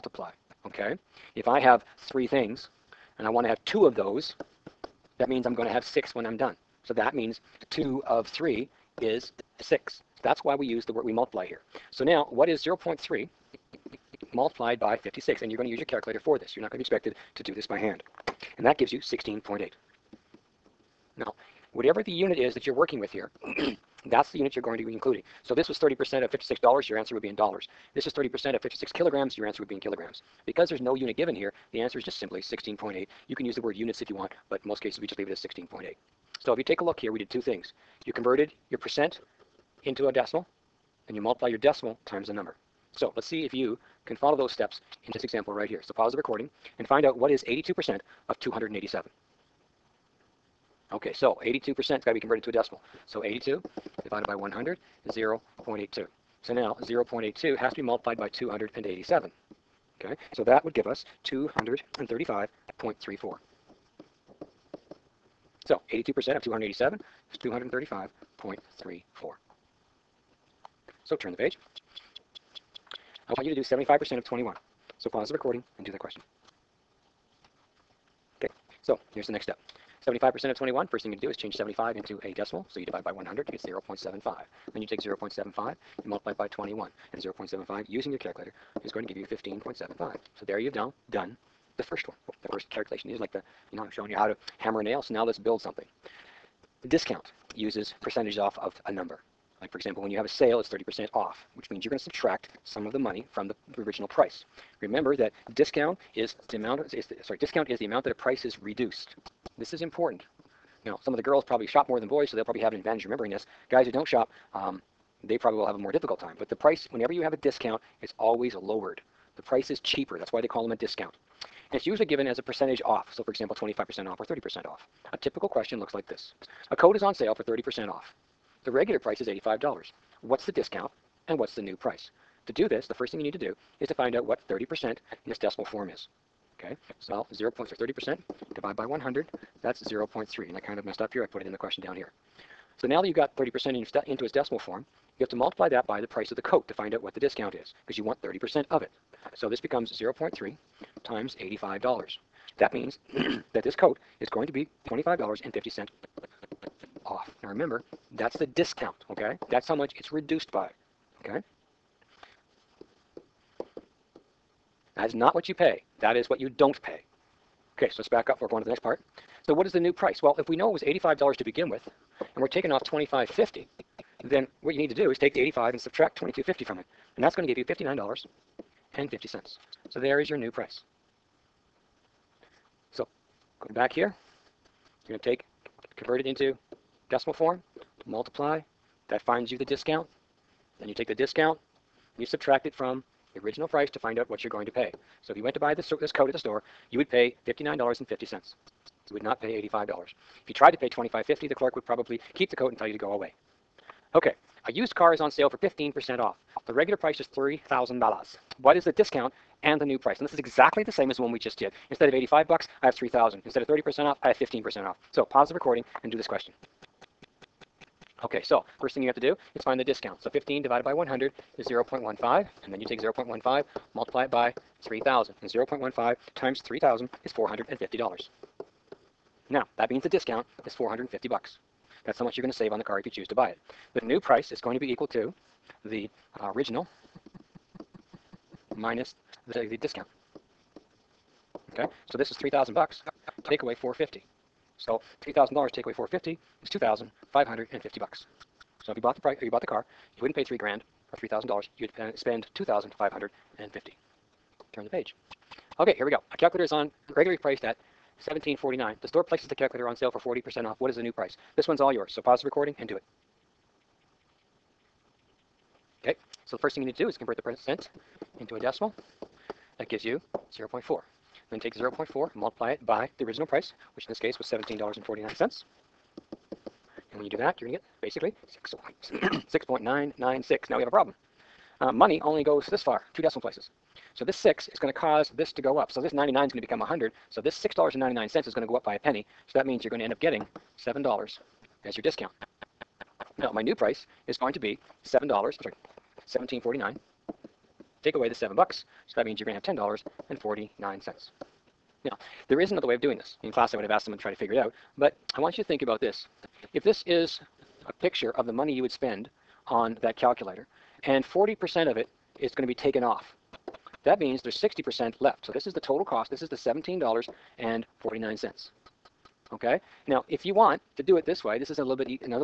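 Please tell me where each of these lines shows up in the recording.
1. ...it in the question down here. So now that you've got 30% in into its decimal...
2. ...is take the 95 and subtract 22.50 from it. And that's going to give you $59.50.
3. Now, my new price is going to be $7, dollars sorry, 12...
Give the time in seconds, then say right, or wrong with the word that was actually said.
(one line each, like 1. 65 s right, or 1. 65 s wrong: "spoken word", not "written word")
1. 141 s right
2. 175 s wrong: "85", not "95"
3. 293 s wrong: "17", not "12".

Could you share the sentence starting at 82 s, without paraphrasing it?
So you divide by 100, you get 0.75.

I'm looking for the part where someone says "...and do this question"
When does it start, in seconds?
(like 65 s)
216 s.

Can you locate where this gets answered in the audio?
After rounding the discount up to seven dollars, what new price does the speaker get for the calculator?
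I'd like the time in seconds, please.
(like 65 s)
299 s.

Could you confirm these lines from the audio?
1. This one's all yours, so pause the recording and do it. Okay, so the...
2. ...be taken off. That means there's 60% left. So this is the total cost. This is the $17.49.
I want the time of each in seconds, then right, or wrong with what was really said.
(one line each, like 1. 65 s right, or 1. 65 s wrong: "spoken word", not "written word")
1. 261 s right
2. 312 s right.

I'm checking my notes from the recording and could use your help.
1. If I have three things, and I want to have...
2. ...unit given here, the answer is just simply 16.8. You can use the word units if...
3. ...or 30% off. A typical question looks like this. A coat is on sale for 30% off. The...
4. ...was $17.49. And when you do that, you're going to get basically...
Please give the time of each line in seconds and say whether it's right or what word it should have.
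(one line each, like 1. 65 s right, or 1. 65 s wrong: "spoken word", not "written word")
1. 1 s right
2. 30 s right
3. 124 s right
4. 274 s right.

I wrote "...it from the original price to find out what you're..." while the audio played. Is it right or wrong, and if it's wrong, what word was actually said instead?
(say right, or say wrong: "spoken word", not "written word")
right.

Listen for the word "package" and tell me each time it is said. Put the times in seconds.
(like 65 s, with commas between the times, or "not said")
not said.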